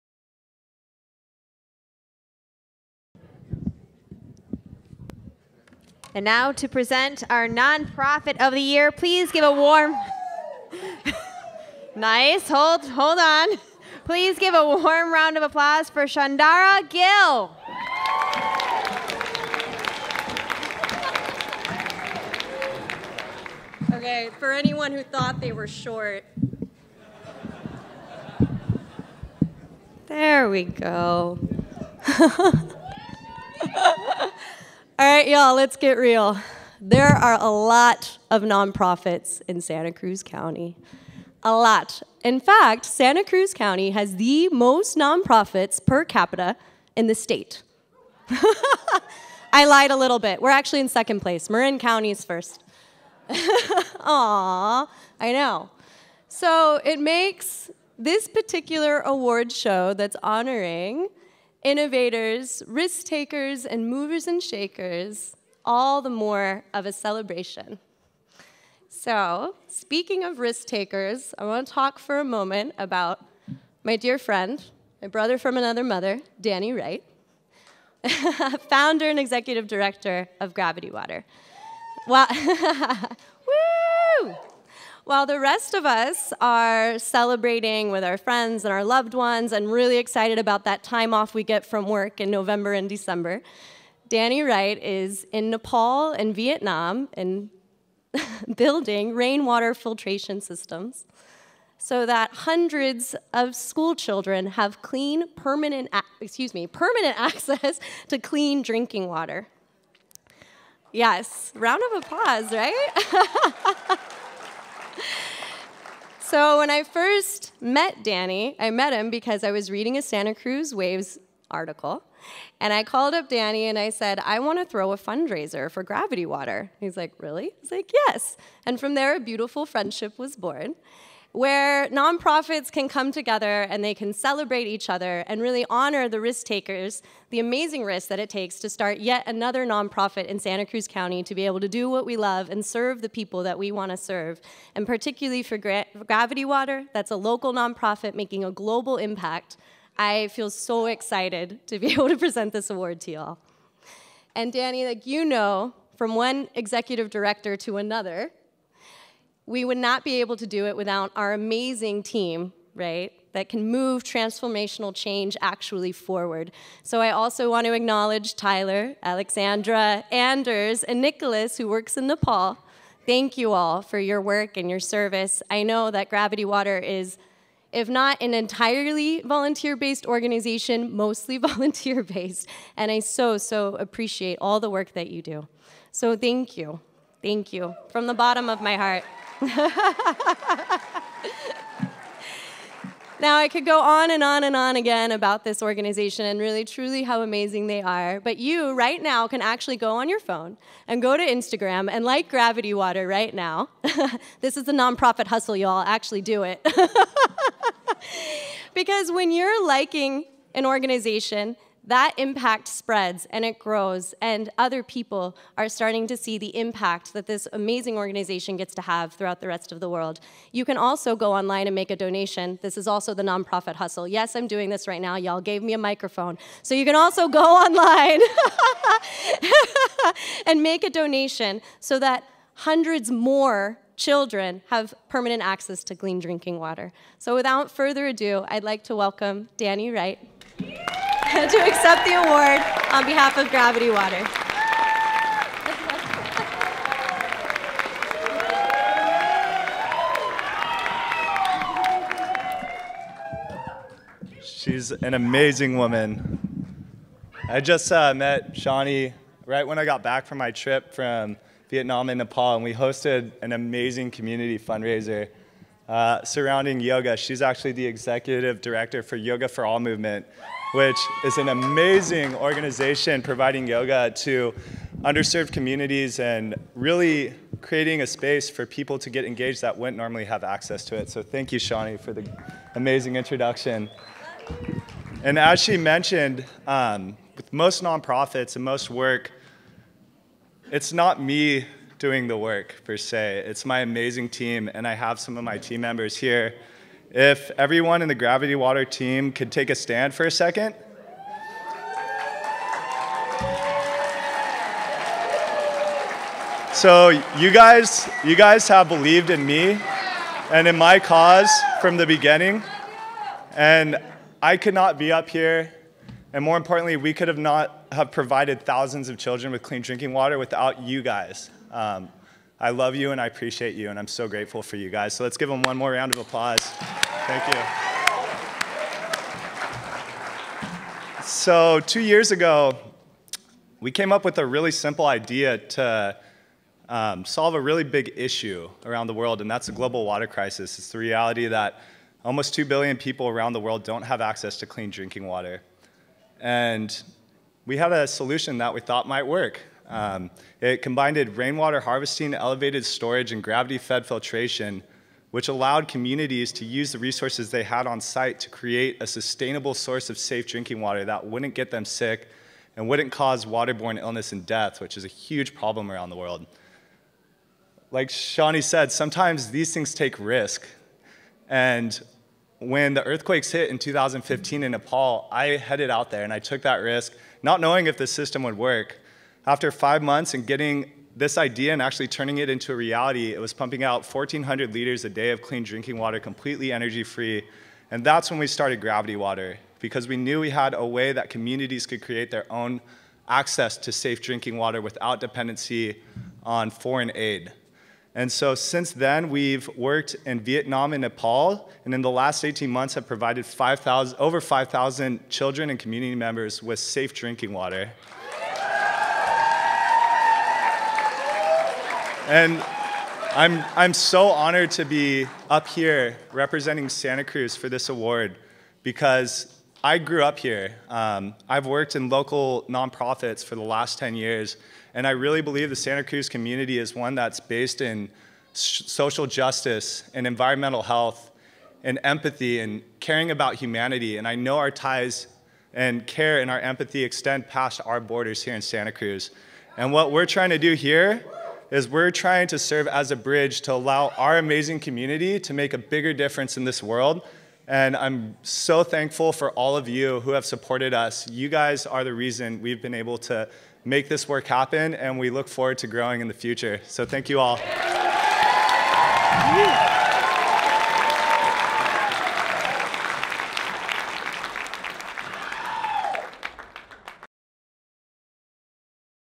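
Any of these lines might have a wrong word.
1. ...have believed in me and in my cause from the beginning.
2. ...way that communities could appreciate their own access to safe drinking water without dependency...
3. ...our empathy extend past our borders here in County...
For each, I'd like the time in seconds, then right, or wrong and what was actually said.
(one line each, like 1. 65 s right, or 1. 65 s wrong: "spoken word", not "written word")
1. 308 s right
2. 390 s wrong: "create", not "appreciate"
3. 436 s wrong: "Santa", not "County".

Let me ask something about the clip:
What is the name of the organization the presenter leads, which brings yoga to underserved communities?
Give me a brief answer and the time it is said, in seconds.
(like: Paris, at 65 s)
Yoga for All, at 269 s.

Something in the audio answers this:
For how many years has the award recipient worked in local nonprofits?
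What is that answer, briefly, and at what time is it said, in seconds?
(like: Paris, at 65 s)
10 years, at 423 s.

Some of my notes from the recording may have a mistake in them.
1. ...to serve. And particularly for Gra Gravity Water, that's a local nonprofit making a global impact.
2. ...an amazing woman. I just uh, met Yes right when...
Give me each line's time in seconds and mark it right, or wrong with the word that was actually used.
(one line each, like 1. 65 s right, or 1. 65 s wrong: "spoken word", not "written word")
1. 143 s right
2. 254 s wrong: "Shawnee", not "Yes".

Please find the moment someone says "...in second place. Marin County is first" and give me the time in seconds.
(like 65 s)
50 s.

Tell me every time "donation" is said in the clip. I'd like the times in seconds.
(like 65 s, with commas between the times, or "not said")
221 s, 230 s.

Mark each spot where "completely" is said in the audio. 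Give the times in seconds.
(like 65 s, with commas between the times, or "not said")
386 s.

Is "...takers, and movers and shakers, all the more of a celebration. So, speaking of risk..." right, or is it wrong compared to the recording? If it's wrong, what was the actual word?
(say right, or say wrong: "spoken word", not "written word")
right.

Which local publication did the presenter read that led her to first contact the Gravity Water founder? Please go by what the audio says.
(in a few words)
Santa Cruz Waves.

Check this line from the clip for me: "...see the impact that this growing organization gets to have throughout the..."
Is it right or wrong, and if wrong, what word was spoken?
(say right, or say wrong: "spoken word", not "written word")
wrong: "amazing", not "growing".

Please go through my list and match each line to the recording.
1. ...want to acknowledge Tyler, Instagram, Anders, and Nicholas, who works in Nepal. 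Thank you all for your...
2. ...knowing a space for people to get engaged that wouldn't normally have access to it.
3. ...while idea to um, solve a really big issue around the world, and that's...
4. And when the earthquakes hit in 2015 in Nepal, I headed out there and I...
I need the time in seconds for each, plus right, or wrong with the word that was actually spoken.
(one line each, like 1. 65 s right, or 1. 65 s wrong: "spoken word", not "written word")
1. 167 s wrong: "Alexandra", not "Instagram"
2. 277 s wrong: "creating", not "knowing"
3. 334 s wrong: "simple", not "while"
4. 371 s right.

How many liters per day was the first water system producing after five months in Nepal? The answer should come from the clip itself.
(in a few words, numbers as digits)
1,400 liters.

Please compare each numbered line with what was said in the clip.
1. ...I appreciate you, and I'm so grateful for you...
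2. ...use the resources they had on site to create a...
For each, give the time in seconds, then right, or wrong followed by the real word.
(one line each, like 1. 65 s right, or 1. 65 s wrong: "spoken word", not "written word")
1. 323 s right
2. 356 s right.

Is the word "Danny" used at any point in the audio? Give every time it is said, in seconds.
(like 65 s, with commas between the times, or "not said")
76 s, 94 s, 118 s, 123 s, 154 s, 239 s.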